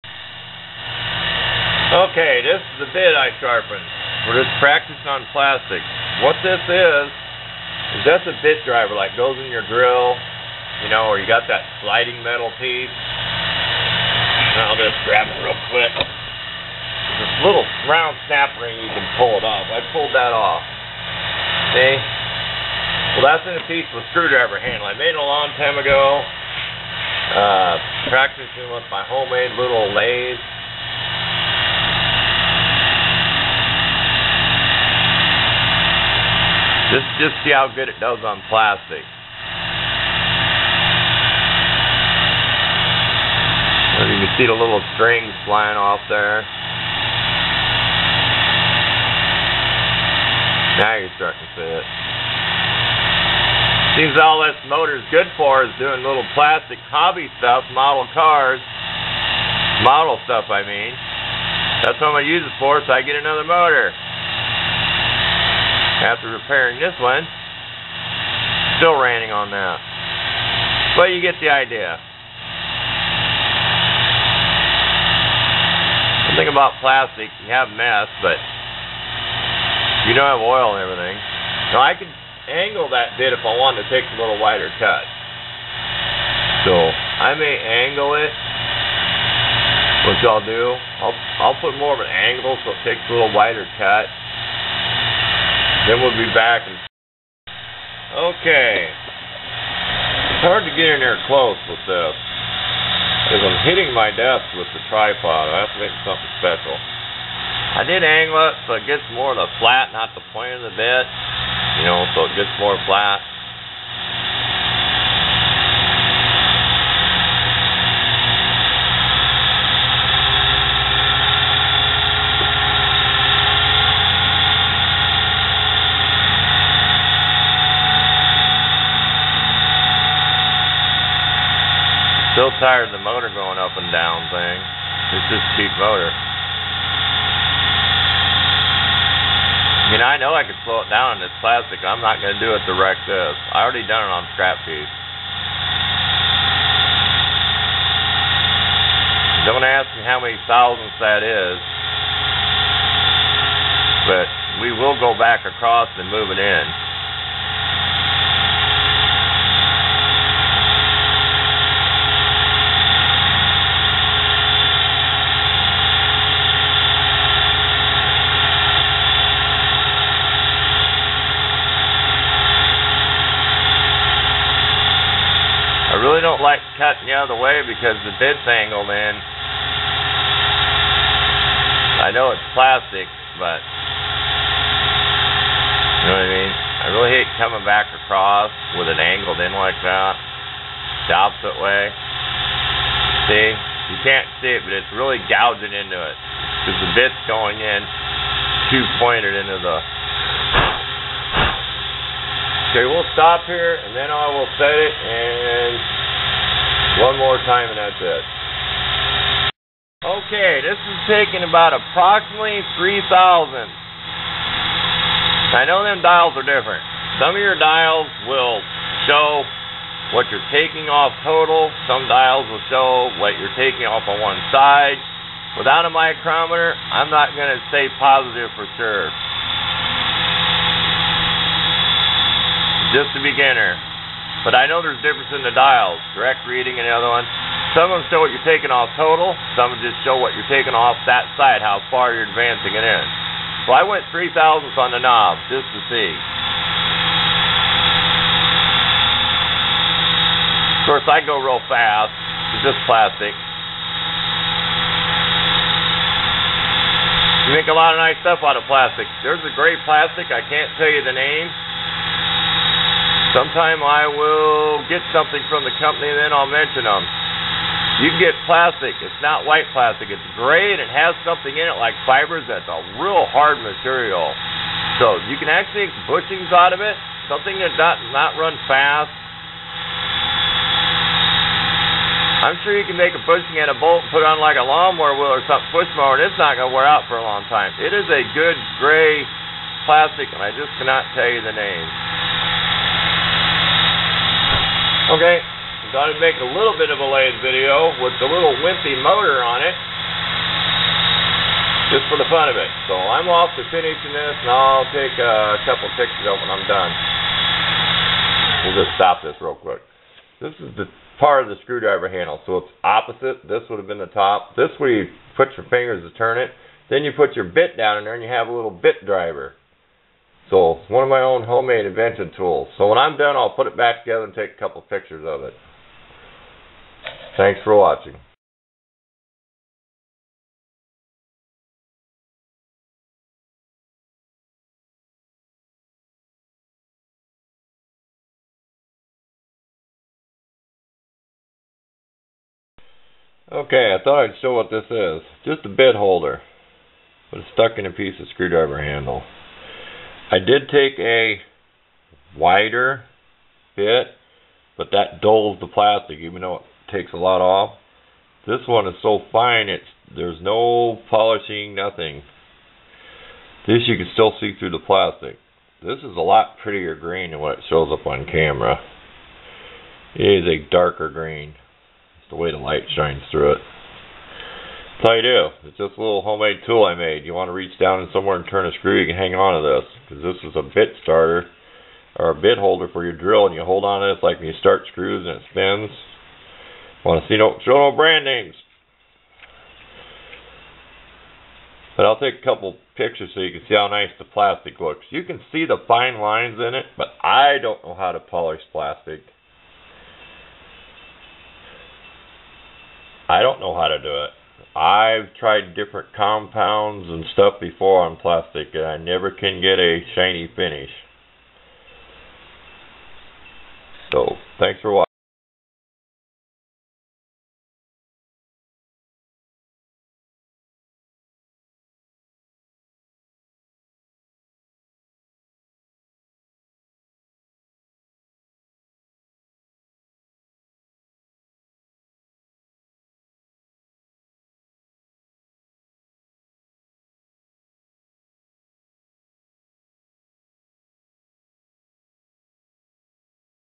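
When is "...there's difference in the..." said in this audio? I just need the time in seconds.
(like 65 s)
234 s.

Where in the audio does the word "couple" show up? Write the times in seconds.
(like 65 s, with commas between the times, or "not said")
305 s, 324 s, 392 s.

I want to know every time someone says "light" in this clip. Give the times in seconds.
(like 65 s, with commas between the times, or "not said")
372 s.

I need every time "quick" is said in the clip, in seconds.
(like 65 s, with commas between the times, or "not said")
15 s, 309 s.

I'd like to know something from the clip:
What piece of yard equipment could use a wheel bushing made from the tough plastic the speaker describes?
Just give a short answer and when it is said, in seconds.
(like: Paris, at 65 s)
Push mower, at 285 s.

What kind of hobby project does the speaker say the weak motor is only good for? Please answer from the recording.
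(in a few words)
Model cars.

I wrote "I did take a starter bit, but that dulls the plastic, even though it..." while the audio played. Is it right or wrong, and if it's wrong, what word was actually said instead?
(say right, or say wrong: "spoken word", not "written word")
wrong: "wider", not "starter".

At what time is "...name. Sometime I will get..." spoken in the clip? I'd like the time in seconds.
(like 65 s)
261 s.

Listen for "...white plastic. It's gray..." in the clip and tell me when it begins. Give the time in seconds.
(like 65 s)
269 s.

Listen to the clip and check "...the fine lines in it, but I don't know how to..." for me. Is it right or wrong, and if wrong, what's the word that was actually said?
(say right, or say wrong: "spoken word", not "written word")
right.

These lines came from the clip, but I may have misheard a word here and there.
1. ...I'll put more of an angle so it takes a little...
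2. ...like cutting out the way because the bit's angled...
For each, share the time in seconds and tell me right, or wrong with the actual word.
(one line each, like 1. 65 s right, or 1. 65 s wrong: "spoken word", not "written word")
1. 91 s right
2. 176 s right.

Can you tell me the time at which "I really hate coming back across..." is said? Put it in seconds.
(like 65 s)
186 s.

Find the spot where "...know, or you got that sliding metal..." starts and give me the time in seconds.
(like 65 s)
10 s.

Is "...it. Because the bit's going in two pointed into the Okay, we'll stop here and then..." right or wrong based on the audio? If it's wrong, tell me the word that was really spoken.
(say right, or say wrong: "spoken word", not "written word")
right.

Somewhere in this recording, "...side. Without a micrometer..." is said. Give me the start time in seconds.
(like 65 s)
224 s.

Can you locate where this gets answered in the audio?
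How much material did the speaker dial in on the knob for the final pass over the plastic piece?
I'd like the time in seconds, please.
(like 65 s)
244 s.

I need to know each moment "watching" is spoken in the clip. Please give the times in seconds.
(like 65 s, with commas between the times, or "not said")
327 s, 414 s.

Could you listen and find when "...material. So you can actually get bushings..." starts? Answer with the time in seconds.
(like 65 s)
273 s.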